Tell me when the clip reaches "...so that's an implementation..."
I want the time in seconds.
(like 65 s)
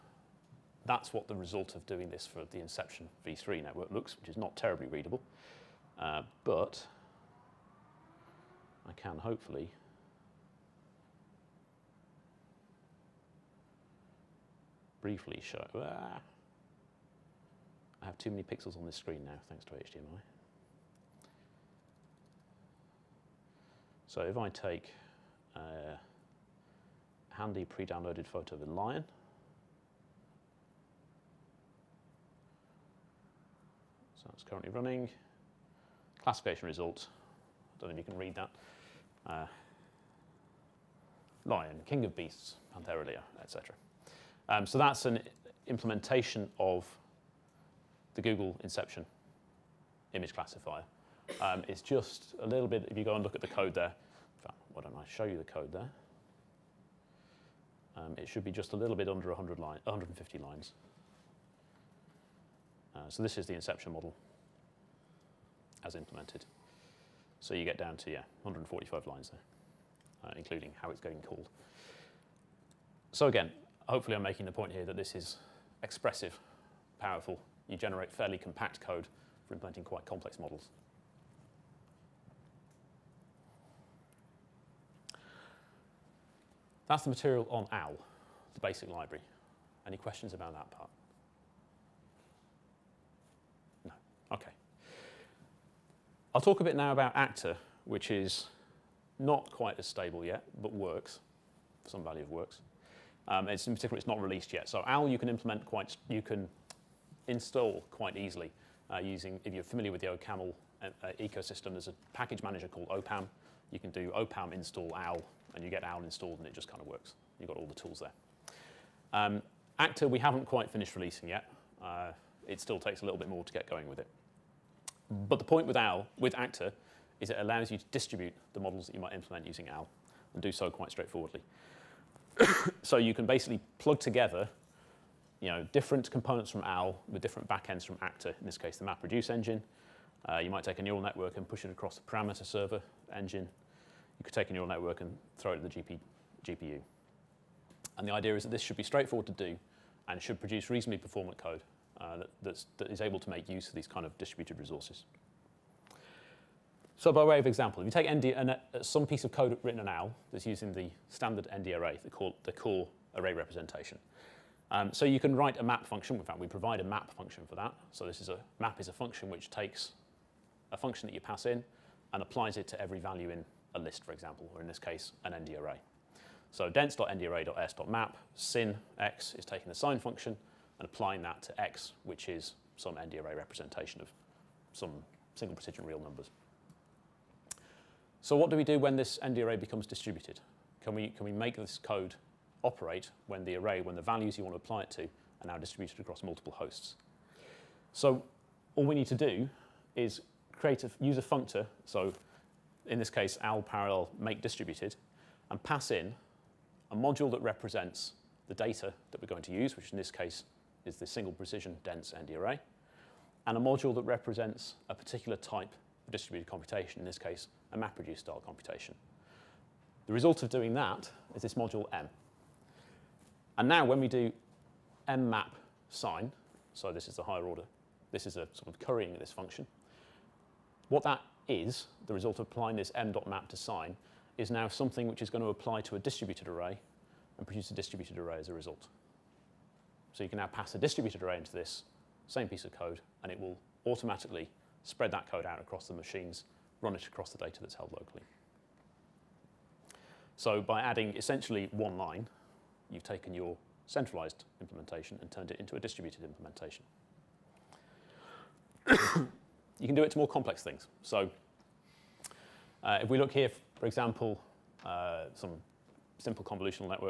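44 s.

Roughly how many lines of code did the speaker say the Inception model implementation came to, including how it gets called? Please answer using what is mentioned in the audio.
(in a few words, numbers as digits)
145.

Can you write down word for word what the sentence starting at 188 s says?
So what do we do when this ND array becomes distributed?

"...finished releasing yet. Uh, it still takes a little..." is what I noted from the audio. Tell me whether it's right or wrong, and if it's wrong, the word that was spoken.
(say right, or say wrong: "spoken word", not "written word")
right.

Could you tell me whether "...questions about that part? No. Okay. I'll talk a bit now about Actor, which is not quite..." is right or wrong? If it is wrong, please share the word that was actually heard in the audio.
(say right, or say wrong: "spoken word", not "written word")
right.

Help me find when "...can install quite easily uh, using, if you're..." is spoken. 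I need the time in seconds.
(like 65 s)
106 s.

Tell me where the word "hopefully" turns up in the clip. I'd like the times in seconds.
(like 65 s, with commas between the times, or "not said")
9 s, 73 s.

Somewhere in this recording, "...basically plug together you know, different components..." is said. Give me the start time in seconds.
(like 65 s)
133 s.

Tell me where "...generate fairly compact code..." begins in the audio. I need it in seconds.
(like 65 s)
77 s.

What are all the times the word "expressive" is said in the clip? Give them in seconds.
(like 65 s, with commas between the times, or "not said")
75 s.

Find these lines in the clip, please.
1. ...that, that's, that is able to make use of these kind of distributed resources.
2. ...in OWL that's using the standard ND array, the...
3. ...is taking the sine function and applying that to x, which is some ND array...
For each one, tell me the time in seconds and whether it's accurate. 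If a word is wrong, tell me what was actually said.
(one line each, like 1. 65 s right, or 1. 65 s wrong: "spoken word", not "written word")
1. 152 s right
2. 159 s right
3. 179 s right.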